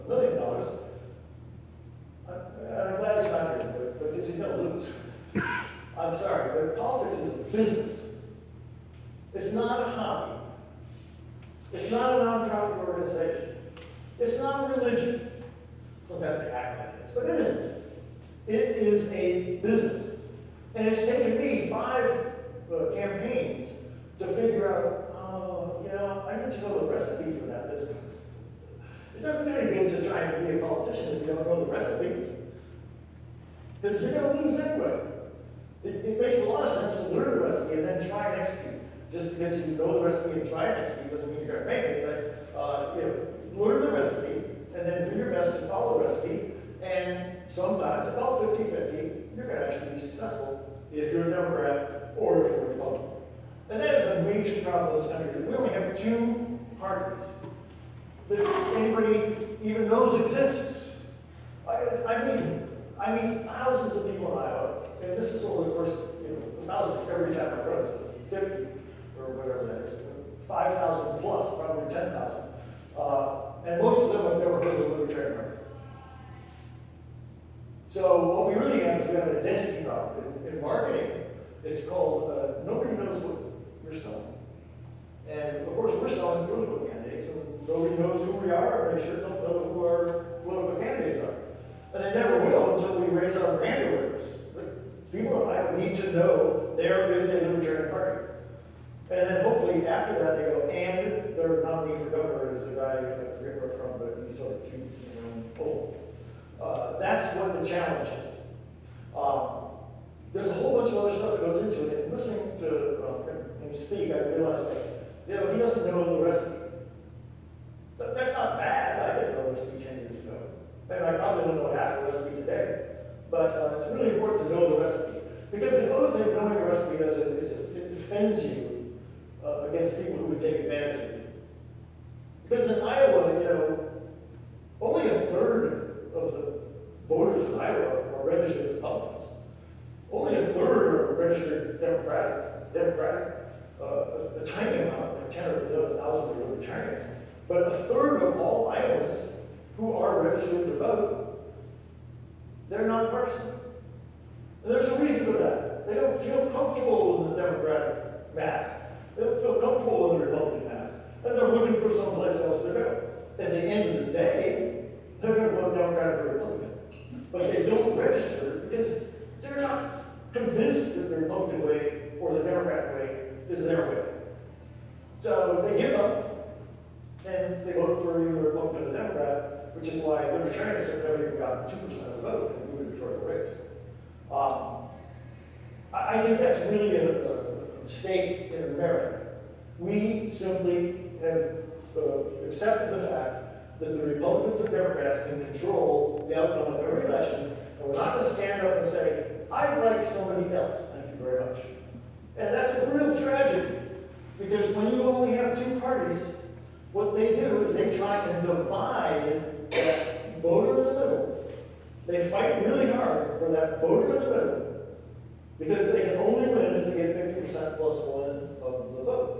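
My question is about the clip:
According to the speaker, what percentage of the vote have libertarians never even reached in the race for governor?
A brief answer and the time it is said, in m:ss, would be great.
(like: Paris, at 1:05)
2%, at 3:01.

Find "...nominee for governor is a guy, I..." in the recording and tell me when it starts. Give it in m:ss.
1:41.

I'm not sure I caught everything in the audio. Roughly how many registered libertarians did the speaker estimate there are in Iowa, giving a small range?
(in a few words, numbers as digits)
10,000 or 11,000.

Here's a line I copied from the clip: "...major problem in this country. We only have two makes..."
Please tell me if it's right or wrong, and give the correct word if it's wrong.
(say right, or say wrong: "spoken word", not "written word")
wrong: "parties", not "makes".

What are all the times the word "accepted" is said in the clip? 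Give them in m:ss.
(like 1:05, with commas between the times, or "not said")
3:12.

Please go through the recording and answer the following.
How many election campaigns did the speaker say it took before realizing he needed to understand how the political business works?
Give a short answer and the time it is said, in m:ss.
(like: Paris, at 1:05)
5, at 0:21.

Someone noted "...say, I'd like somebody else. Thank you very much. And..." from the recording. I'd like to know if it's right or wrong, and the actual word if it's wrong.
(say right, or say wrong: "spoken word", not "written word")
right.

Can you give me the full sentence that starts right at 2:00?
And I probably don't know half the recipe today.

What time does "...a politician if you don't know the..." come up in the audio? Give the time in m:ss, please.
0:30.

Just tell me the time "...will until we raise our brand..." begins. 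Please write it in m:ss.
1:32.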